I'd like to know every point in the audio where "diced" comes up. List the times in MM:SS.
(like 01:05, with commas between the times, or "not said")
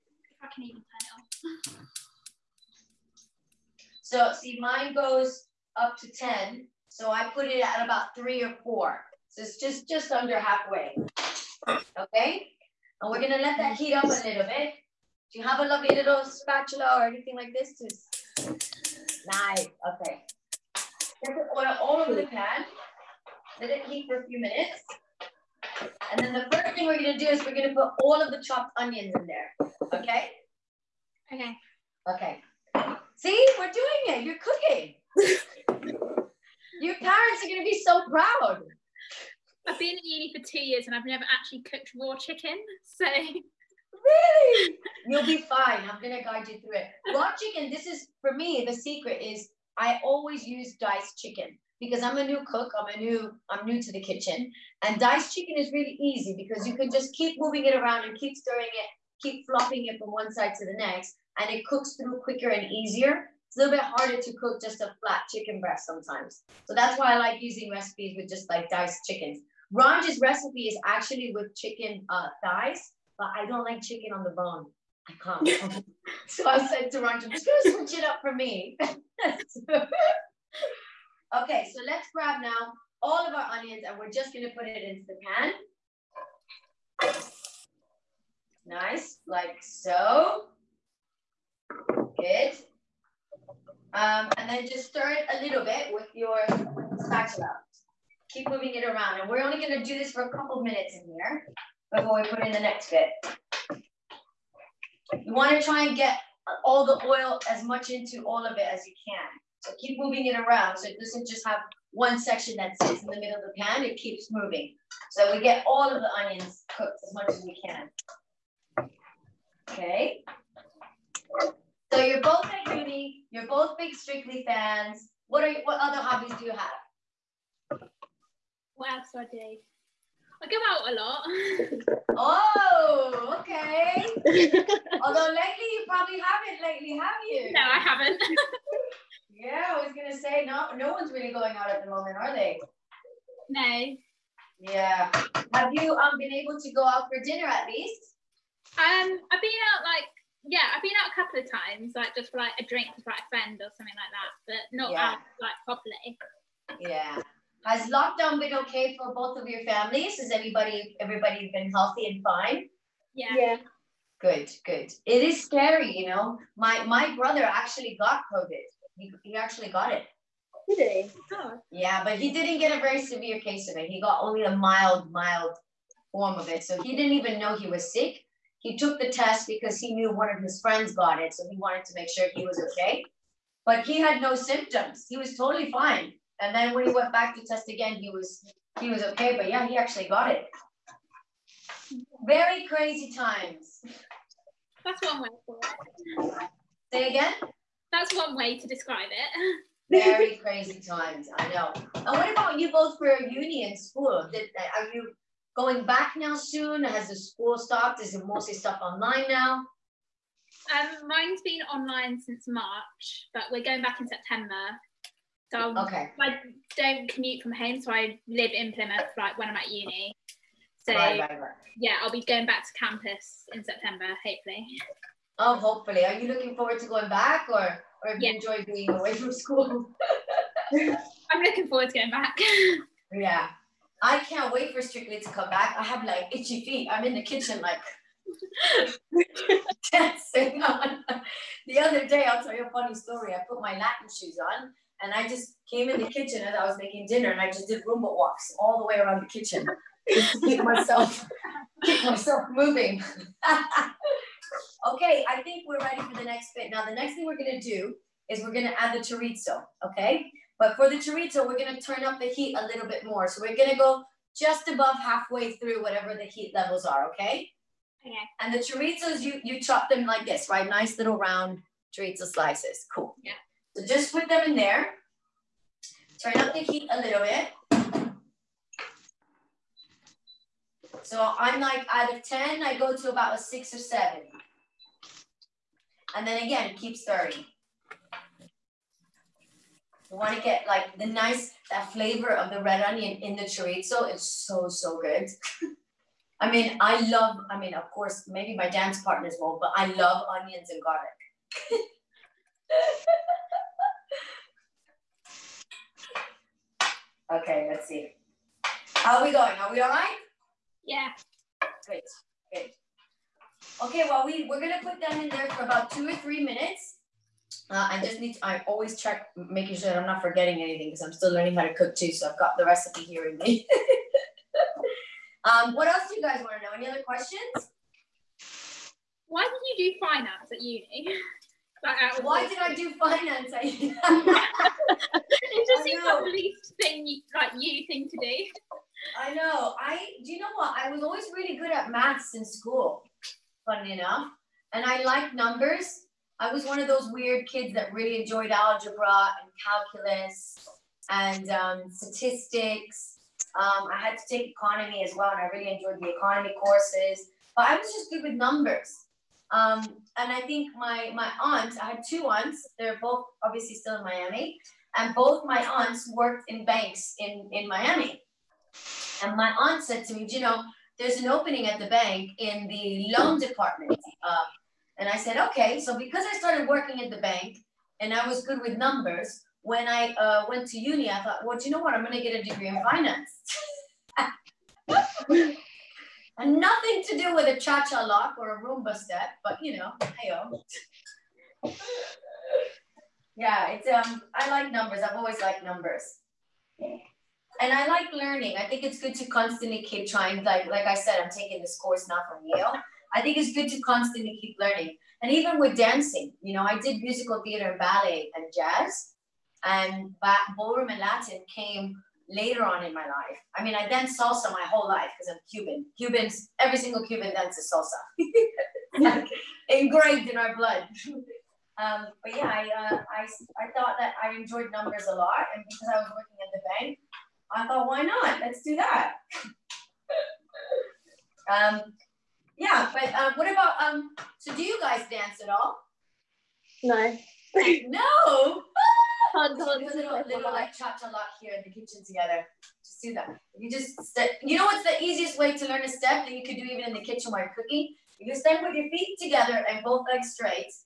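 00:50, 00:54, 01:08.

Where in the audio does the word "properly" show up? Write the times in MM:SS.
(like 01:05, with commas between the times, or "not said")
02:35.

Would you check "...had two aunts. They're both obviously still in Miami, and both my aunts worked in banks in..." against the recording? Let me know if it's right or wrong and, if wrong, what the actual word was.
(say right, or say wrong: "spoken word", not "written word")
right.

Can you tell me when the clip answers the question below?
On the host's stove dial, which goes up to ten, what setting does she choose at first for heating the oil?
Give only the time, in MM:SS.
00:07.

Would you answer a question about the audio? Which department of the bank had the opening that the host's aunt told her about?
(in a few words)
Loan department.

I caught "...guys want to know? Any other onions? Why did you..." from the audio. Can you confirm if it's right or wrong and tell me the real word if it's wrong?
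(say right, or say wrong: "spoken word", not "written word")
wrong: "questions", not "onions".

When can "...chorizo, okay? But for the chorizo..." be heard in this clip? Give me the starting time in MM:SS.
04:18.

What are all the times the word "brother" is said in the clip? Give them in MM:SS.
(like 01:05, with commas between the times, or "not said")
02:47.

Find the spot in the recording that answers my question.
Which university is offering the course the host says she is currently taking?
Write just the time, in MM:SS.
06:42.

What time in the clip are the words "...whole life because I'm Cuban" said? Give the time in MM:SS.
06:54.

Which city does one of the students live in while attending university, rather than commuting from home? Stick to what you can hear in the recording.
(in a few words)
Plymouth.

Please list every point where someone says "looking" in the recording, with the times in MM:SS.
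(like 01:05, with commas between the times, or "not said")
03:46, 03:51.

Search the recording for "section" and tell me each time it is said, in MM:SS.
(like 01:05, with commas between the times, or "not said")
01:52.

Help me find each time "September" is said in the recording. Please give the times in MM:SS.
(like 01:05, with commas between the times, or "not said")
03:34, 03:43.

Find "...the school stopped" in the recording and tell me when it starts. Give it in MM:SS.
03:27.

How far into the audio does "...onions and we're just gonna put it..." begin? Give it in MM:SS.
01:23.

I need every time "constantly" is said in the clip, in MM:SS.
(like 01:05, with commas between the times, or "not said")
06:39, 06:43.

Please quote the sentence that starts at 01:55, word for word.
So we get all of the onions cooked as much as we can.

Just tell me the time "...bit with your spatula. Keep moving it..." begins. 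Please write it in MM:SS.
01:35.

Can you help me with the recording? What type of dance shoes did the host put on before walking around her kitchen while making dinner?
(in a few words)
Latin shoes.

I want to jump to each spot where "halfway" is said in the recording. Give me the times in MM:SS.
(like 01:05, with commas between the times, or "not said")
00:10, 04:24.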